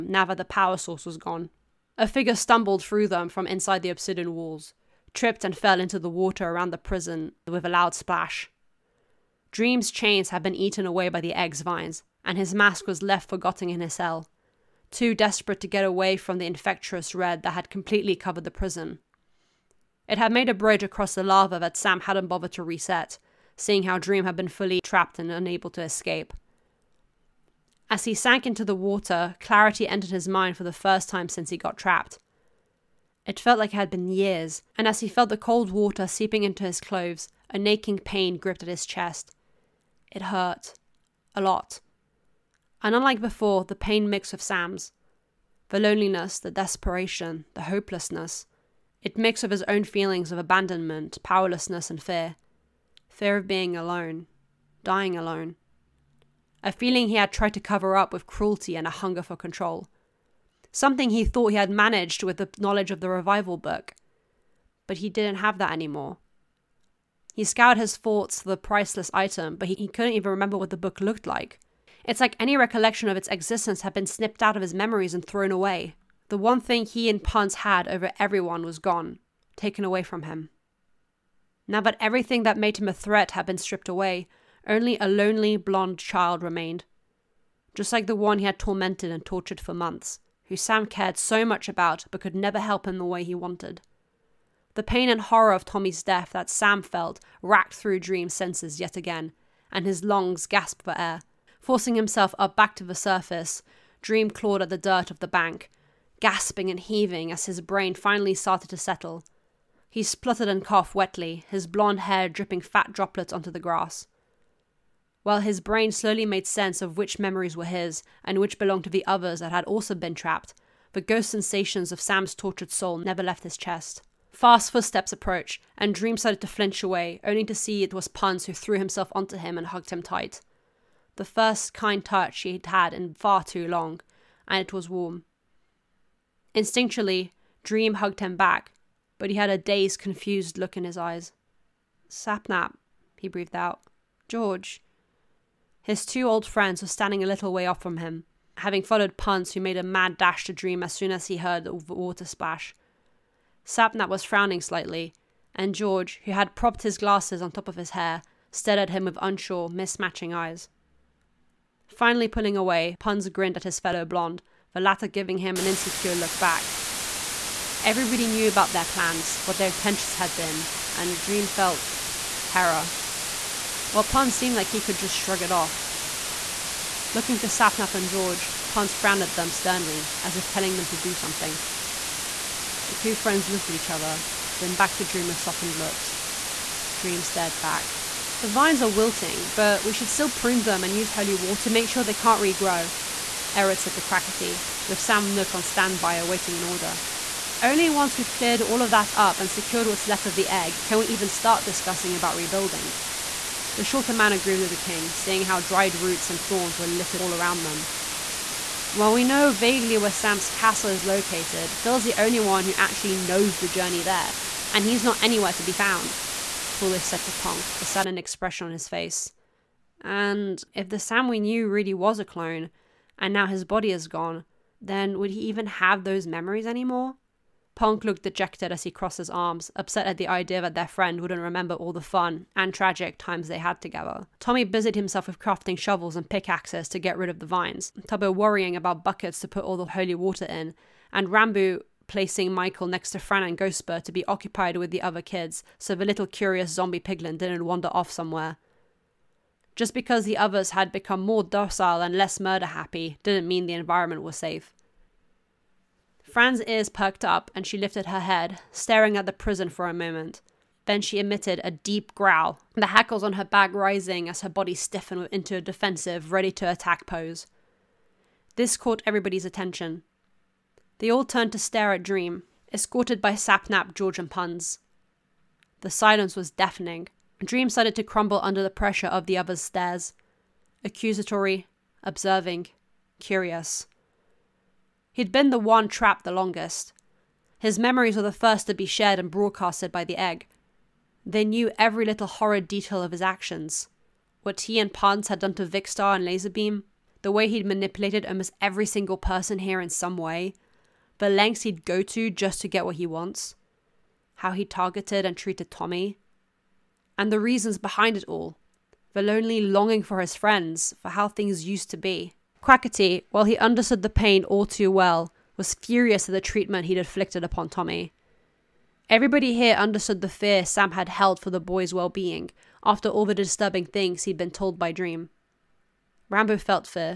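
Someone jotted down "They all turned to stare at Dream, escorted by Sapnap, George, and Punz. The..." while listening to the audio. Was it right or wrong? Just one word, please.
right.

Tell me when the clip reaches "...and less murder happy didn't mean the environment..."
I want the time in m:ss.
4:12.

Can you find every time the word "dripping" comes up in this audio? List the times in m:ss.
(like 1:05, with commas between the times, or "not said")
1:52.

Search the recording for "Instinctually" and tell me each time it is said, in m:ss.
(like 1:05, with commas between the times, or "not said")
2:16.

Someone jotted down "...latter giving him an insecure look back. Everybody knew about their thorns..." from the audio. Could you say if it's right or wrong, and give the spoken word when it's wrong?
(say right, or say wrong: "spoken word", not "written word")
wrong: "plans", not "thorns".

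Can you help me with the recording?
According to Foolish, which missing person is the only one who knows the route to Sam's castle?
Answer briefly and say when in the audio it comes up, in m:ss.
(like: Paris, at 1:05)
Phil, at 3:31.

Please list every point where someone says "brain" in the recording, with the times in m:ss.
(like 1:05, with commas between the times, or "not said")
1:47, 1:55.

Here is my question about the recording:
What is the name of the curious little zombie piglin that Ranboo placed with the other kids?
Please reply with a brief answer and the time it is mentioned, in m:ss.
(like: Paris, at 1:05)
Michael, at 4:02.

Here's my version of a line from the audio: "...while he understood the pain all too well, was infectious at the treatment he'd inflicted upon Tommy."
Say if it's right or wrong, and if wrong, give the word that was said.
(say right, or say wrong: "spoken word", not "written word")
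wrong: "furious", not "infectious".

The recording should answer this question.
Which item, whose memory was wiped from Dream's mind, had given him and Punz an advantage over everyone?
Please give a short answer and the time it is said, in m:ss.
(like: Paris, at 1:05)
Revival book, at 1:03.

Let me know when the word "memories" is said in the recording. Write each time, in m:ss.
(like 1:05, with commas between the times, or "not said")
1:14, 1:57, 3:46, 4:47.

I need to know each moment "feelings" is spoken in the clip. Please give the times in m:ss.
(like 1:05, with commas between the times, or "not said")
0:49, 0:56.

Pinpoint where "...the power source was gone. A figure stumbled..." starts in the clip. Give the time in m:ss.
0:00.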